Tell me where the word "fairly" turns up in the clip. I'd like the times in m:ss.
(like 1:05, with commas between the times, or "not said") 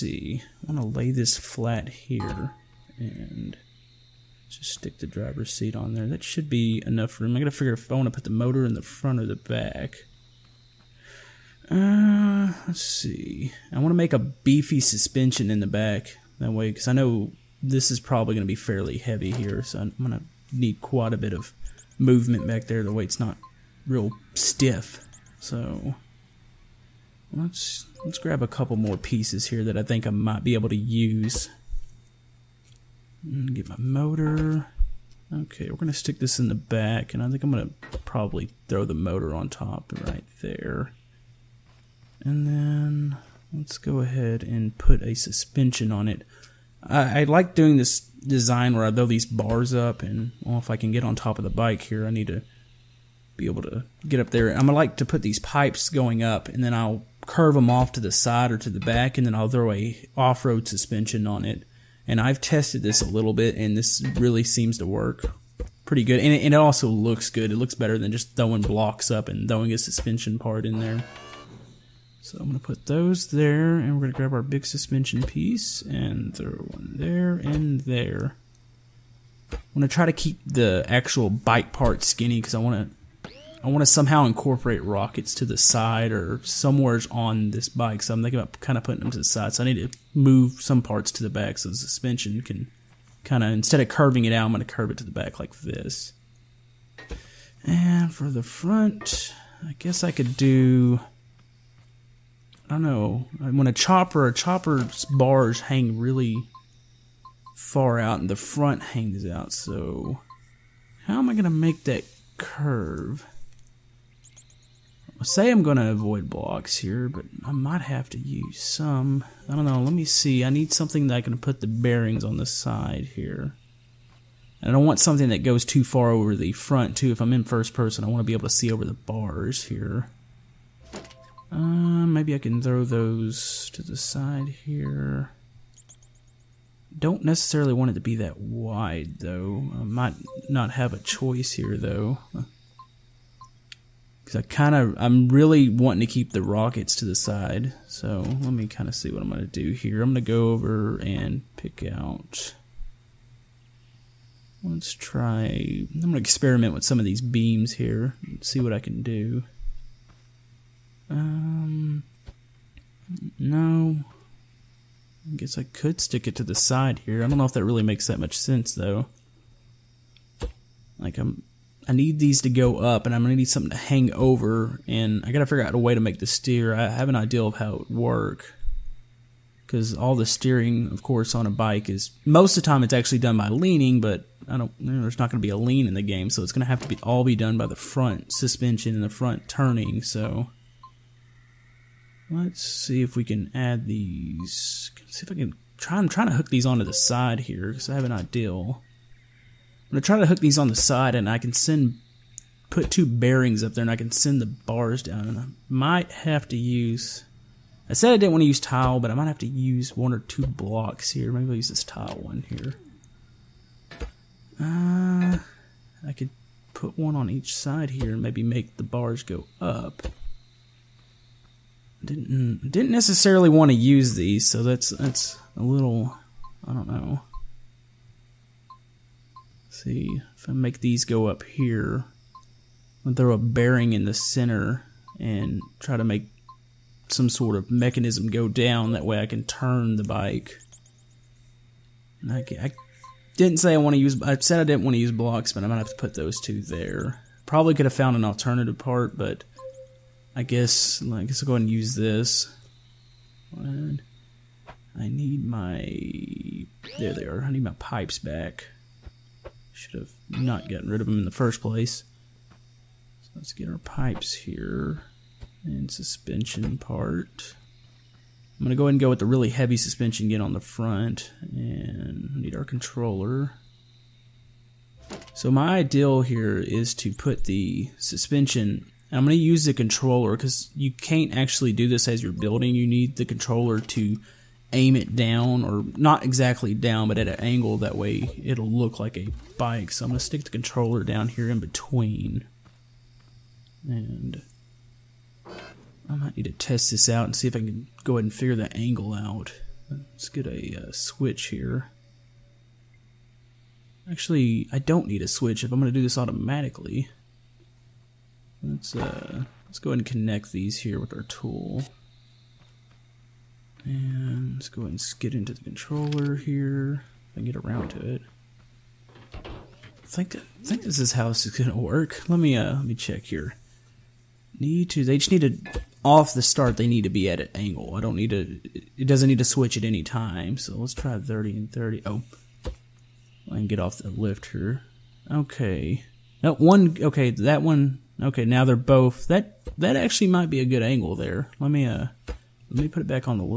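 0:18.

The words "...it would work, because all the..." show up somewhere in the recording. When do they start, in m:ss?
2:57.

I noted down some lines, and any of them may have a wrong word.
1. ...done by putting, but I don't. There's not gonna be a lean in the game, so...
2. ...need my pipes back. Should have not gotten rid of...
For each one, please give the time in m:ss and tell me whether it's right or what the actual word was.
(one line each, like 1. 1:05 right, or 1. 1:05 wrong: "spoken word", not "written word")
1. 3:03 wrong: "leaning", not "putting"
2. 4:17 right.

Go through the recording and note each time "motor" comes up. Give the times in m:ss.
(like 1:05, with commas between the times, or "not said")
0:08, 0:33, 0:38.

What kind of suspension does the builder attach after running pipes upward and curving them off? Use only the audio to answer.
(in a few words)
Off-road suspension.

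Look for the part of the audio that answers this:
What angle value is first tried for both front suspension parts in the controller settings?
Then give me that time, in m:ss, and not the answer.
5:31.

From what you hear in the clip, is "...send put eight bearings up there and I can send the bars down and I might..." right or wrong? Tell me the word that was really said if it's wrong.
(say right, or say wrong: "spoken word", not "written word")
wrong: "two", not "eight".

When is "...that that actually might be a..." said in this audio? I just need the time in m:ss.
5:39.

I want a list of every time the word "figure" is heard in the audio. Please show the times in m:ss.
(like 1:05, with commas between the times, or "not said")
0:07, 2:55, 4:58.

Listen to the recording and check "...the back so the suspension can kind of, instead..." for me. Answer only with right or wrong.
right.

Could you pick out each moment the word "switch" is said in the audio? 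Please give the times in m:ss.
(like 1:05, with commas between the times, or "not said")
5:00, 5:05, 5:29.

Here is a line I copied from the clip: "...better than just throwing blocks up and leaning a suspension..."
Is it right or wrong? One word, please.
wrong.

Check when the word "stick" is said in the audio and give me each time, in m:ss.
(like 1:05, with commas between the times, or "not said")
0:04, 0:35, 2:46, 4:50.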